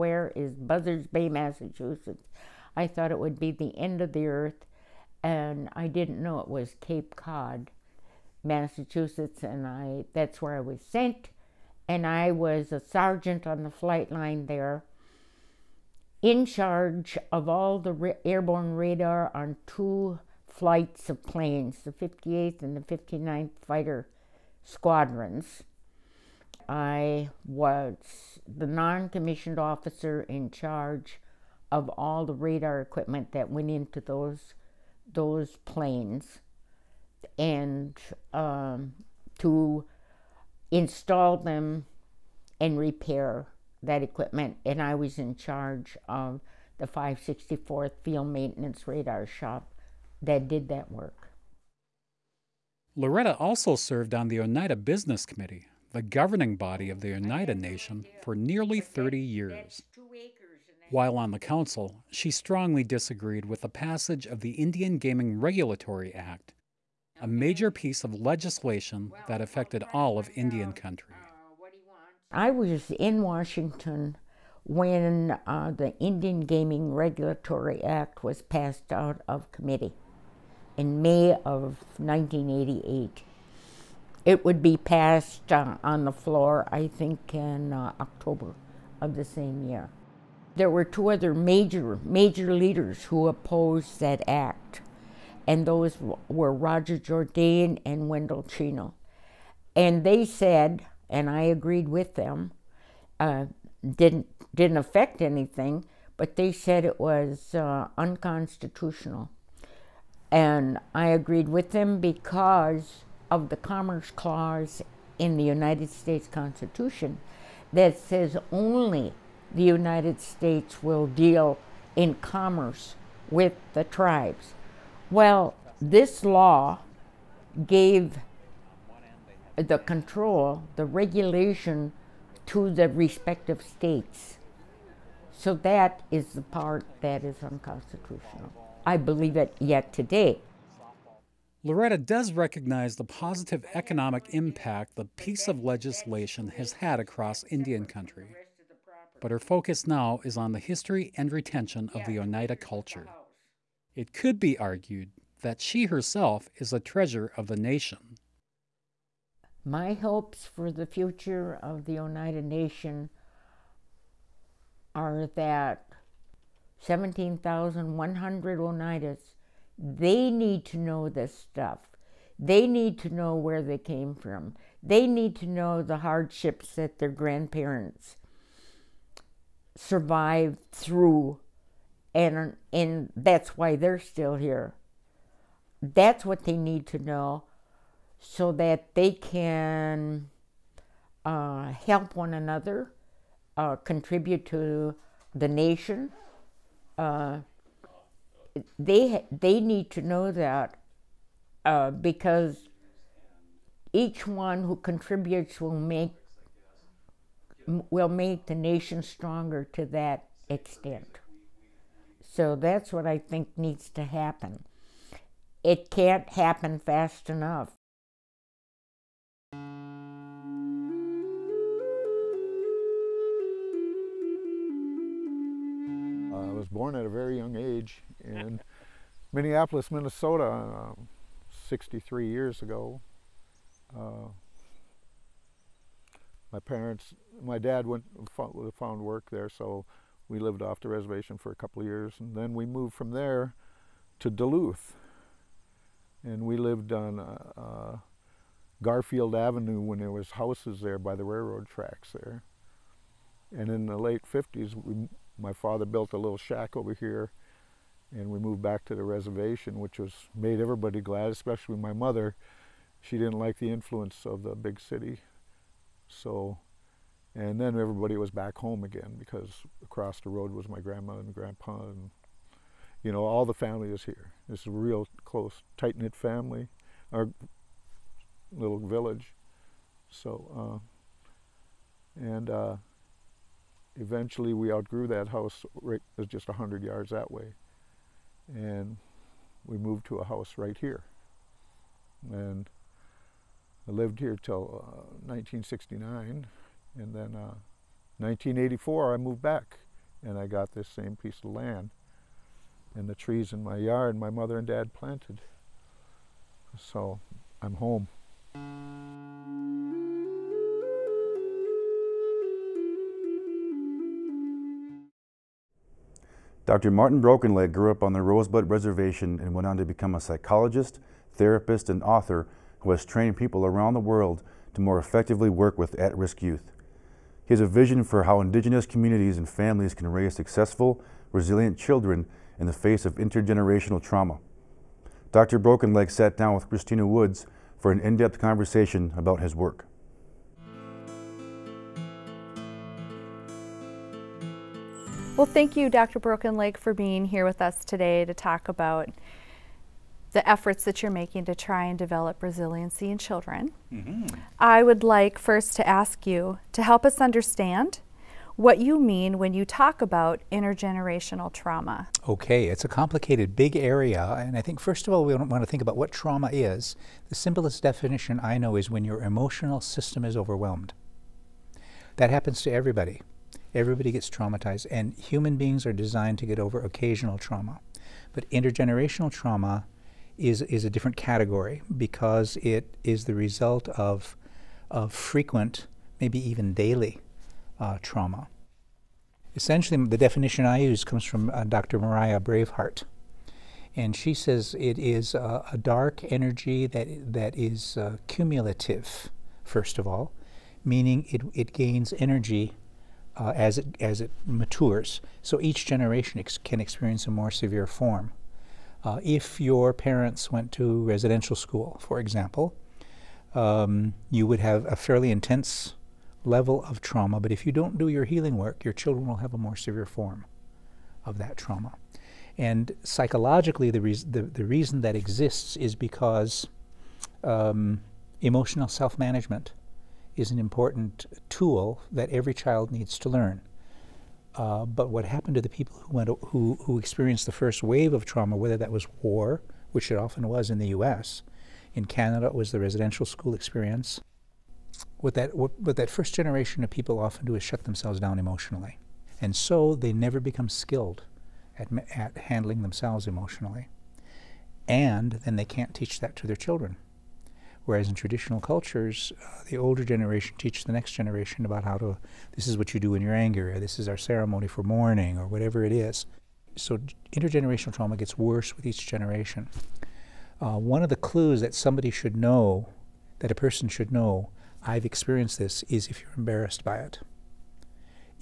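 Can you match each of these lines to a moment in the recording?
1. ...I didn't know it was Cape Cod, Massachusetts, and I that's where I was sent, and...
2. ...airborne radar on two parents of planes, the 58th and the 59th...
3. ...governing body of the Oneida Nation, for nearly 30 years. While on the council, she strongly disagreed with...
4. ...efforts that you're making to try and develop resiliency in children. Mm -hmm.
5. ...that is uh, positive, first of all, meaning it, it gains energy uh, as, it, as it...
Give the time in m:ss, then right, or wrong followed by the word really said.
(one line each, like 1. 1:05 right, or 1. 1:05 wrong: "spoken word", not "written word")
1. 0:05 right
2. 0:18 wrong: "flights", not "parents"
3. 0:56 right
4. 5:50 right
5. 6:37 wrong: "cumulative", not "positive".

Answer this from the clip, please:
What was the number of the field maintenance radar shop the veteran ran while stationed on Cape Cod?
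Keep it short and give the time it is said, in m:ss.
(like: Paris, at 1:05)
564th, at 0:46.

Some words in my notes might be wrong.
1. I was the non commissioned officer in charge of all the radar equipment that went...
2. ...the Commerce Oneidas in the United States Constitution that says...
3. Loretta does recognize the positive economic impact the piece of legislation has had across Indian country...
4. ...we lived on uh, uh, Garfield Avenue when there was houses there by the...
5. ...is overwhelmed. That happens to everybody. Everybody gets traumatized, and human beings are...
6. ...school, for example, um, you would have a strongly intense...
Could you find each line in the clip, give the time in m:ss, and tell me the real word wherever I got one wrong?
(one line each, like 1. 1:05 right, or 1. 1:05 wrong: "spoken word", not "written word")
1. 0:26 right
2. 1:53 wrong: "Clause", not "Oneidas"
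3. 2:21 right
4. 4:06 right
5. 6:10 right
6. 6:51 wrong: "fairly", not "strongly".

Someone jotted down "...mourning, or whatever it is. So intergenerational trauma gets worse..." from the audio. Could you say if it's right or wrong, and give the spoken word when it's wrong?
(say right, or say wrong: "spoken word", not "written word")
right.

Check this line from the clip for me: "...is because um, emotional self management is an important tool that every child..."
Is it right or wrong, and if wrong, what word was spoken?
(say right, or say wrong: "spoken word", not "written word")
right.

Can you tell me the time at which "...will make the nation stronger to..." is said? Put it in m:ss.
3:27.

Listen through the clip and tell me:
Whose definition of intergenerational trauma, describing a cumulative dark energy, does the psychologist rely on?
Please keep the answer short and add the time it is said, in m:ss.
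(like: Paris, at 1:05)
Dr. Mariah Braveheart, at 6:31.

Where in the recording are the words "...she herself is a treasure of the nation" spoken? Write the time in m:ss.
2:35.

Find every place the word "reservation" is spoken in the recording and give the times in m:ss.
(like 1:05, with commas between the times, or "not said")
4:00, 4:19, 5:18.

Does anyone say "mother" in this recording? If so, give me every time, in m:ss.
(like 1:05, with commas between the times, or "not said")
4:21, 5:04.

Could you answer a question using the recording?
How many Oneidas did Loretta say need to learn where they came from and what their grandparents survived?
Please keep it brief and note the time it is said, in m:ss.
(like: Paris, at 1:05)
17,100, at 2:46.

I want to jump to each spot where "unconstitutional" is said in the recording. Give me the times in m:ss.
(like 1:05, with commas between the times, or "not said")
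1:47, 2:17.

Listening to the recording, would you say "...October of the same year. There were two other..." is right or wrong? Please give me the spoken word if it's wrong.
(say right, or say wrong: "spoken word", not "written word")
right.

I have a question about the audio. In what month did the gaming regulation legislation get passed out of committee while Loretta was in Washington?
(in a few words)
May.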